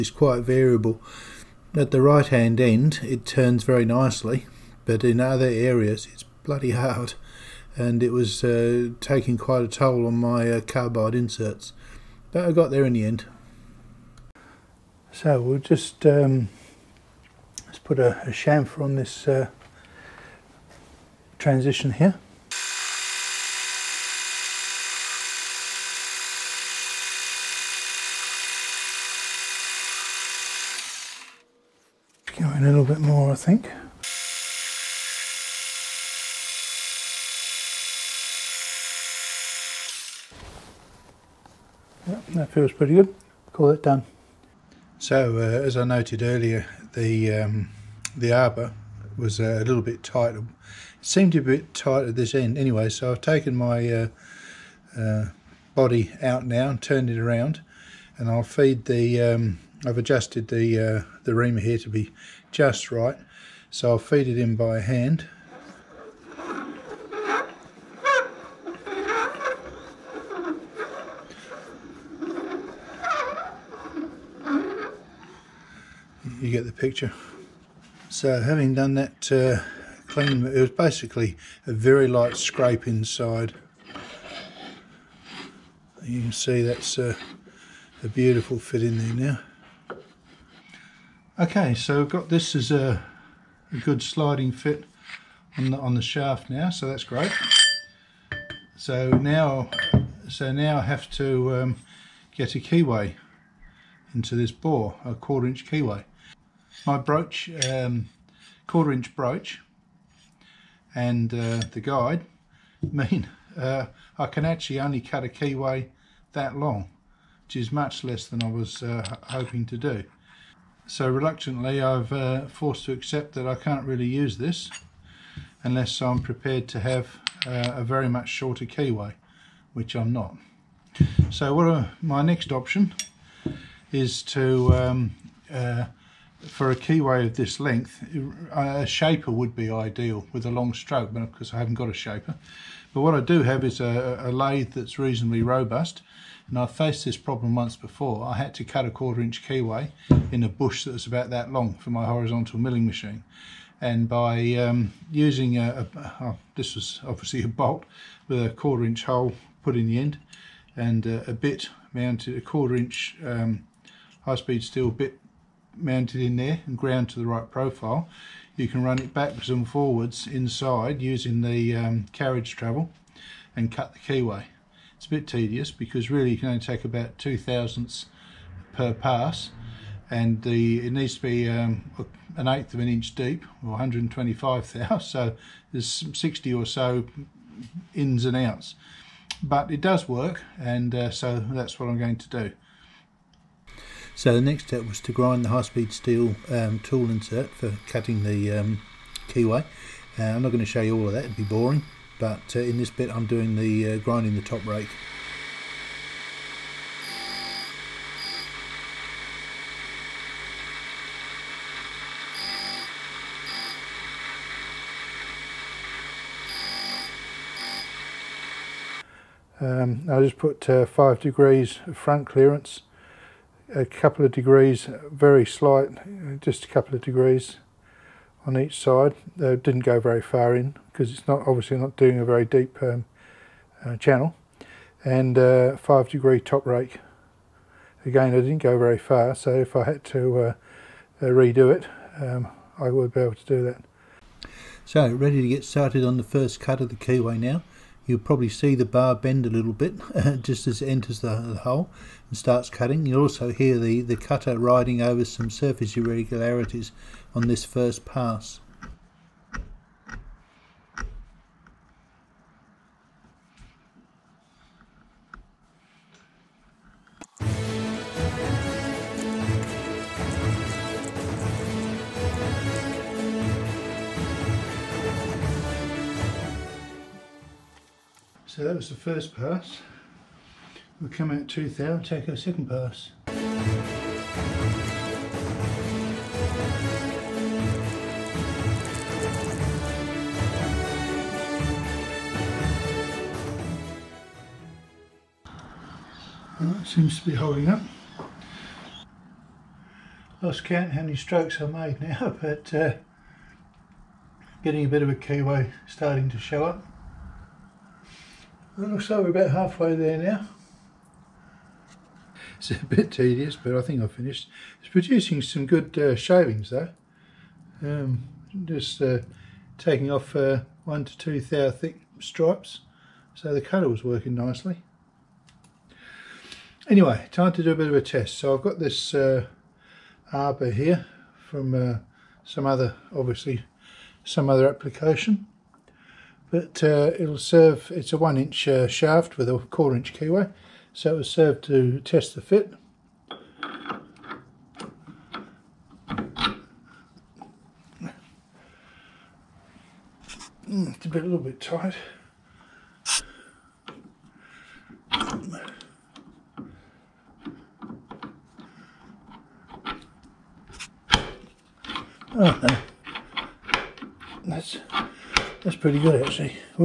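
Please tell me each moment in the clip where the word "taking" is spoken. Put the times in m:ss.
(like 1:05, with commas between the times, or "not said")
0:08, 5:19.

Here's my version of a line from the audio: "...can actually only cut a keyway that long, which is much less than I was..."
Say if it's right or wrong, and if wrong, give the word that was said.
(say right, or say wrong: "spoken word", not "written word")
right.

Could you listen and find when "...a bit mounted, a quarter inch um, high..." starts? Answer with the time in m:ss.
2:41.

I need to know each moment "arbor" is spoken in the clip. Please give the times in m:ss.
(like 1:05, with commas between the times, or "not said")
0:48, 5:30.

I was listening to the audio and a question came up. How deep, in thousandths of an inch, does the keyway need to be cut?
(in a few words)
125 thou.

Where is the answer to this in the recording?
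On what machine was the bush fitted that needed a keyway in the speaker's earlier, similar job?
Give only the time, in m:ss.
2:32.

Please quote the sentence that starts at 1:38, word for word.
So now, so now I have to um, get a keyway into this bore, a quarter inch keyway.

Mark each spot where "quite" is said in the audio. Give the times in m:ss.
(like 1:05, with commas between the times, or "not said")
0:00, 0:09.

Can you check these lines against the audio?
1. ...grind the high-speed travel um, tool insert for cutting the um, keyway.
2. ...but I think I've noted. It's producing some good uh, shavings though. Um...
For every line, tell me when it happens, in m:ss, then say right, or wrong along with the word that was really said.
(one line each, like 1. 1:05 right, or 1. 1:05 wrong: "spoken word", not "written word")
1. 3:15 wrong: "steel", not "travel"
2. 5:13 wrong: "finished", not "noted".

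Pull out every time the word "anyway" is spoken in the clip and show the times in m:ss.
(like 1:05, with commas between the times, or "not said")
0:52, 5:26.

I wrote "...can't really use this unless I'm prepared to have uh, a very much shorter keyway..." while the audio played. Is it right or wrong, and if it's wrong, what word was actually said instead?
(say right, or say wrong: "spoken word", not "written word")
right.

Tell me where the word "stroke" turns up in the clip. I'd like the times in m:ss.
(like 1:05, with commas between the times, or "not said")
2:20, 5:01.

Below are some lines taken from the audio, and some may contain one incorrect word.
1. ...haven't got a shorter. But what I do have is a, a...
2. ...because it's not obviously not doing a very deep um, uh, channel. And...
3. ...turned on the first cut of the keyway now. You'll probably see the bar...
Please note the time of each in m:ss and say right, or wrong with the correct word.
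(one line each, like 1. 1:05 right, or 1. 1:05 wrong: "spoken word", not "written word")
1. 2:21 wrong: "shaper", not "shorter"
2. 3:50 right
3. 4:05 wrong: "started", not "turned".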